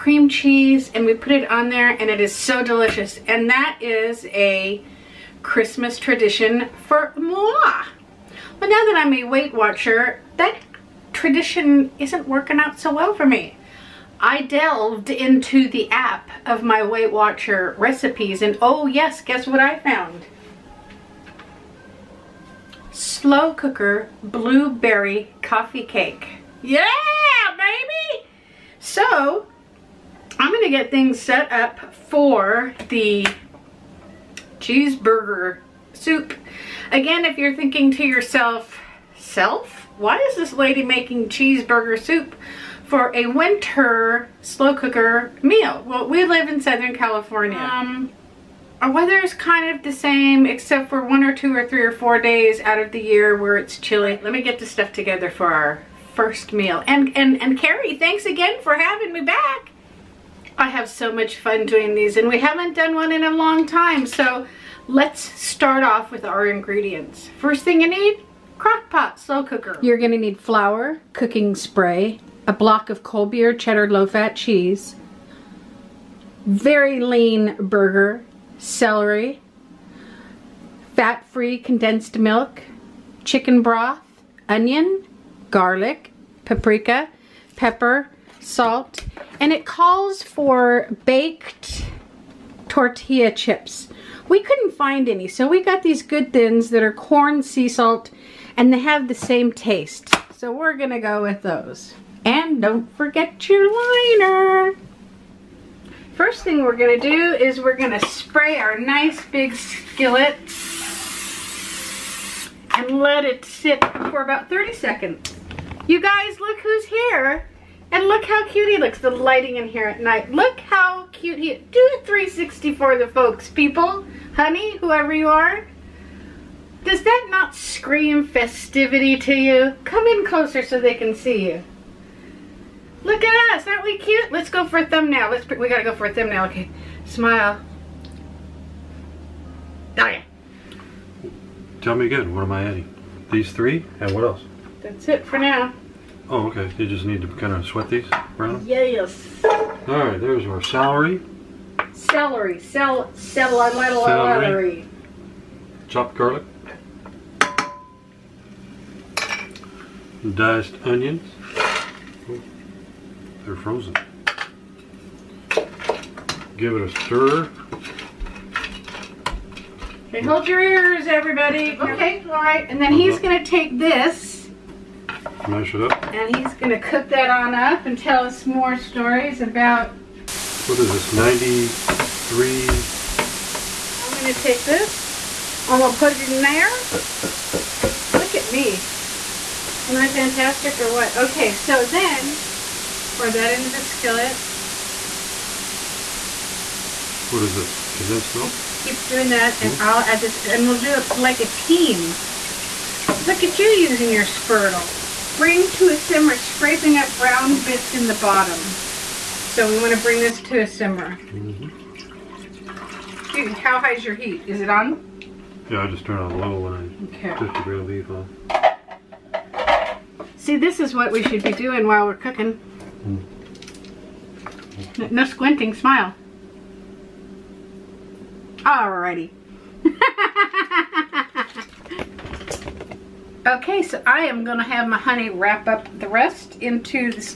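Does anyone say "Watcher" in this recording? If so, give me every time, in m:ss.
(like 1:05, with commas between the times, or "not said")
0:09, 0:17.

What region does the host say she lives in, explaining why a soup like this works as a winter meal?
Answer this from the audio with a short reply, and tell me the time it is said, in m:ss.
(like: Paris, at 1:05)
Southern California, at 0:46.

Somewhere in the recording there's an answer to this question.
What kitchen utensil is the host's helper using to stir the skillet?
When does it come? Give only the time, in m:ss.
3:24.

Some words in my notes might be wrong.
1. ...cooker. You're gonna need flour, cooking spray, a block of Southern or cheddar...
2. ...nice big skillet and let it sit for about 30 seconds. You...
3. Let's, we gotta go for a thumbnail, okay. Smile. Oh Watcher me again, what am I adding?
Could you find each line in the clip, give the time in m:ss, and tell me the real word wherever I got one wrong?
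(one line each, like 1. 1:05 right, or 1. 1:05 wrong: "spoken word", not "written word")
1. 1:09 wrong: "Colby", not "Southern"
2. 1:48 right
3. 2:15 wrong: "Tell", not "Watcher".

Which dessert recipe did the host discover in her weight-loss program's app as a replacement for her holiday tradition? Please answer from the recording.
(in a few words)
Slow cooker blueberry coffee cake.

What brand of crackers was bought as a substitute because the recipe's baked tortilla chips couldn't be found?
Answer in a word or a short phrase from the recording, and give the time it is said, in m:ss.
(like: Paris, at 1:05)
Good Thins, at 1:36.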